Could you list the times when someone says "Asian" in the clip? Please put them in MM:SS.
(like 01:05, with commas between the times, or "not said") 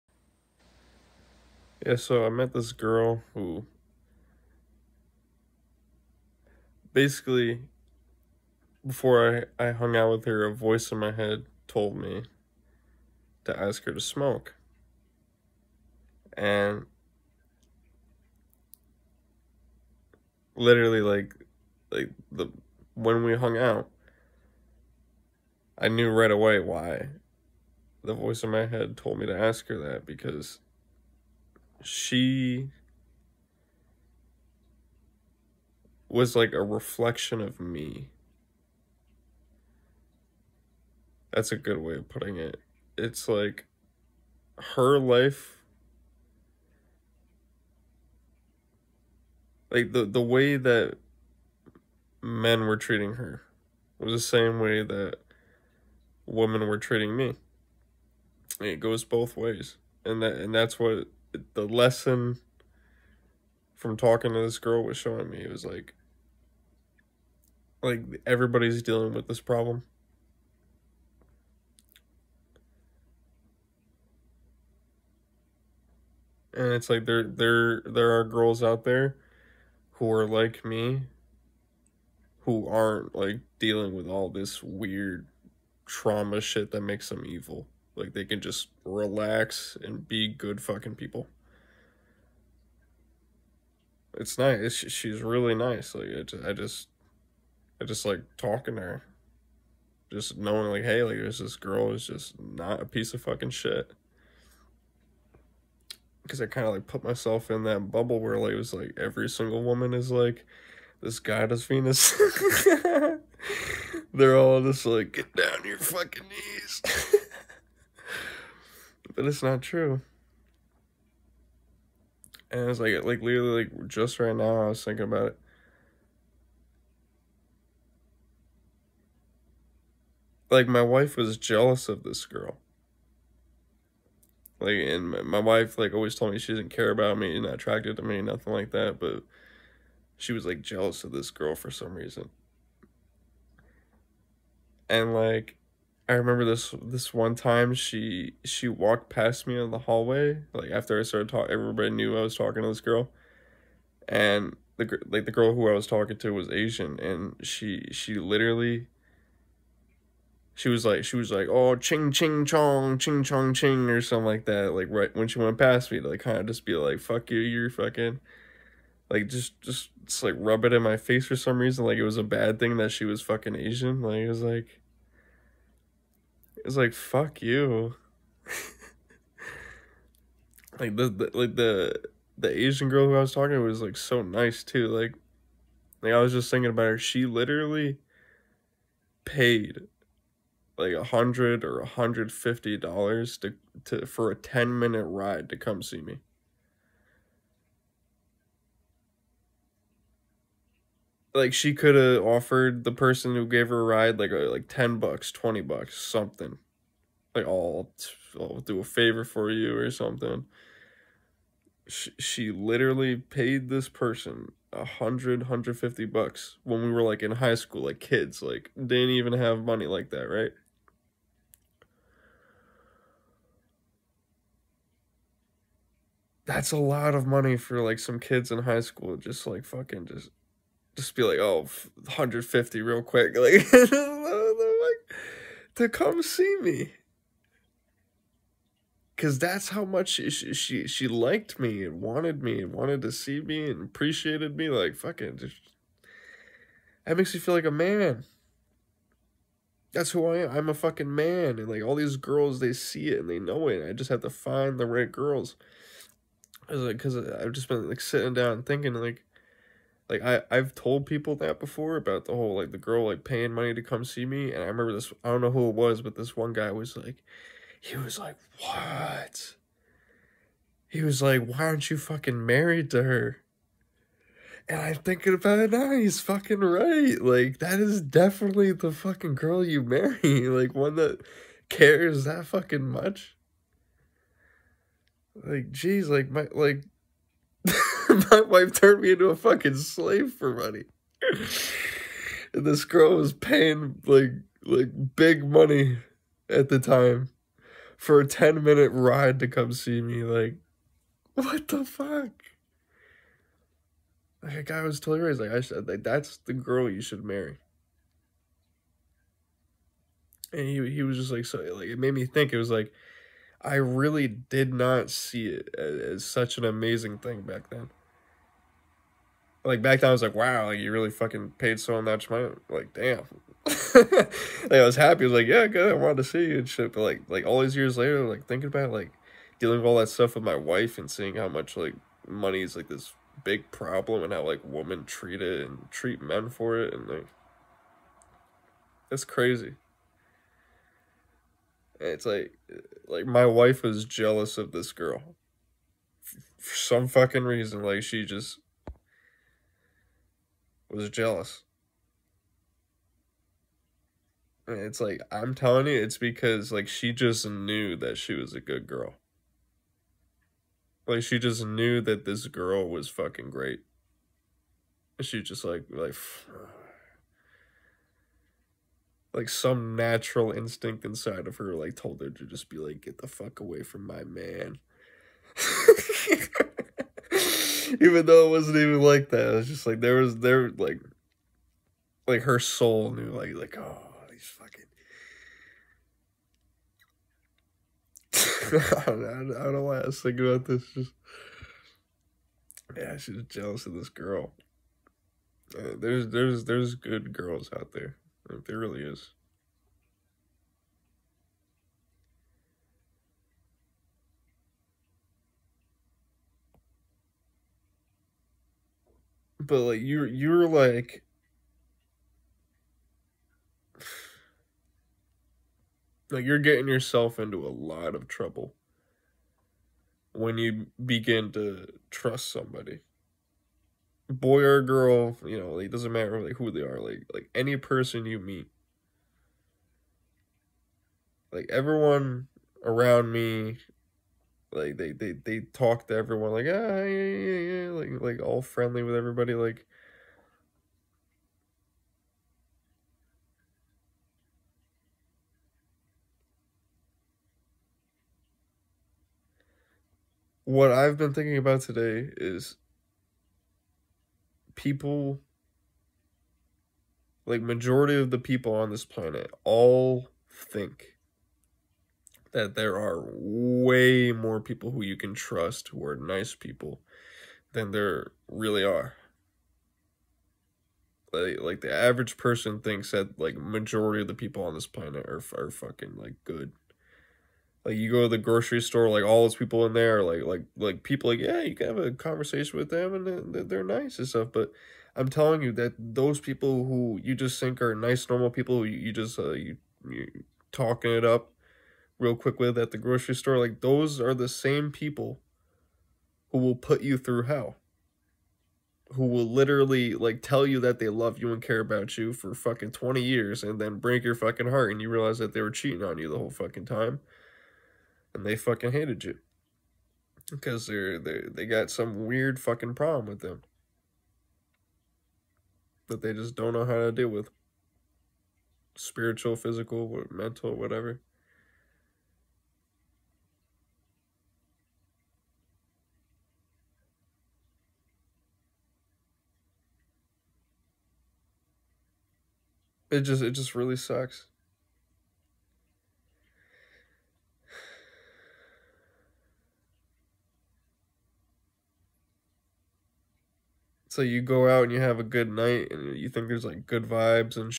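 02:36, 02:53, 03:02.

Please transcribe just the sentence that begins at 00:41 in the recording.
That's a good way of putting it.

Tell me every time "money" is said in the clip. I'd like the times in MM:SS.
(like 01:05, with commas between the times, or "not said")
03:39, 03:47, 04:23, 04:50, 04:55, 05:22, 05:32.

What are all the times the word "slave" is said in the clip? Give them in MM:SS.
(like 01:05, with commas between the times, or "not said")
04:49.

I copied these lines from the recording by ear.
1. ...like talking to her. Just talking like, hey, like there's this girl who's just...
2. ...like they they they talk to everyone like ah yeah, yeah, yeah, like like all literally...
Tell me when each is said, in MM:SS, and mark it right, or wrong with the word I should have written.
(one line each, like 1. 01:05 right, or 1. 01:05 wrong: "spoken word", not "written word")
1. 01:38 wrong: "knowing", not "talking"
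2. 07:14 wrong: "friendly", not "literally".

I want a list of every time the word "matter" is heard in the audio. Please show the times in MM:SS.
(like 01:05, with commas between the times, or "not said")
07:06.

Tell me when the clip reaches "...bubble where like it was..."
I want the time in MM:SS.
01:47.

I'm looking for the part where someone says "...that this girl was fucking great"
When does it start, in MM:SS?
06:02.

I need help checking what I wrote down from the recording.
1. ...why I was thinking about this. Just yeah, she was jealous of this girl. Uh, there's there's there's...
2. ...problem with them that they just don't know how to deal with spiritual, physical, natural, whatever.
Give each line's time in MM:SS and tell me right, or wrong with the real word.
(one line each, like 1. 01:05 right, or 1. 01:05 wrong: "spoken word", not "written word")
1. 06:29 right
2. 08:32 wrong: "mental", not "natural".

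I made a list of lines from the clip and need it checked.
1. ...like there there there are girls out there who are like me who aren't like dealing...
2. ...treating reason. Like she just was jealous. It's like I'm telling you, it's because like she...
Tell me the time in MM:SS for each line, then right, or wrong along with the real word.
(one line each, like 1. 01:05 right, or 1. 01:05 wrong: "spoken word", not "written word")
1. 01:16 right
2. 05:47 wrong: "fucking", not "treating".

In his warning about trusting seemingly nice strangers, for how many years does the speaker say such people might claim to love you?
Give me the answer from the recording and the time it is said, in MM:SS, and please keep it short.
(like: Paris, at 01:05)
20 years, at 08:22.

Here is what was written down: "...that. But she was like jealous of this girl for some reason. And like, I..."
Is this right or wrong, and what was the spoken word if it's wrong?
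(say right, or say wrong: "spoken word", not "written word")
right.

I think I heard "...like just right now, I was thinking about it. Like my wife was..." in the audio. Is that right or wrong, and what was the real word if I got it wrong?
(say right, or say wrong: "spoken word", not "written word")
right.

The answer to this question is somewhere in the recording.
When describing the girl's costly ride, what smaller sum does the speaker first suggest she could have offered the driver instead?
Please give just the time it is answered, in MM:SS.
03:24.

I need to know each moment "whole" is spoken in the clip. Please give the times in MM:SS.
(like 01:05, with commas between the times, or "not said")
04:22, 08:26.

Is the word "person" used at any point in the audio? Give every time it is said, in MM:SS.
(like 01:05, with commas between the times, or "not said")
03:22, 03:33, 07:07, 07:52.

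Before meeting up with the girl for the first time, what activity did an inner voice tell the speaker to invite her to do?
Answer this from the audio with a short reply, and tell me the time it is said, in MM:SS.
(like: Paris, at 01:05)
smoke, at 00:13.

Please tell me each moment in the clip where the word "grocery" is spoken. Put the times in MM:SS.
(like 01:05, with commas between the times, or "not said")
07:58, 08:12.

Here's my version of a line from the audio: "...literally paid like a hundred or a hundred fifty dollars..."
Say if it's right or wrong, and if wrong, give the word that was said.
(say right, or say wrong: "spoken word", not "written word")
right.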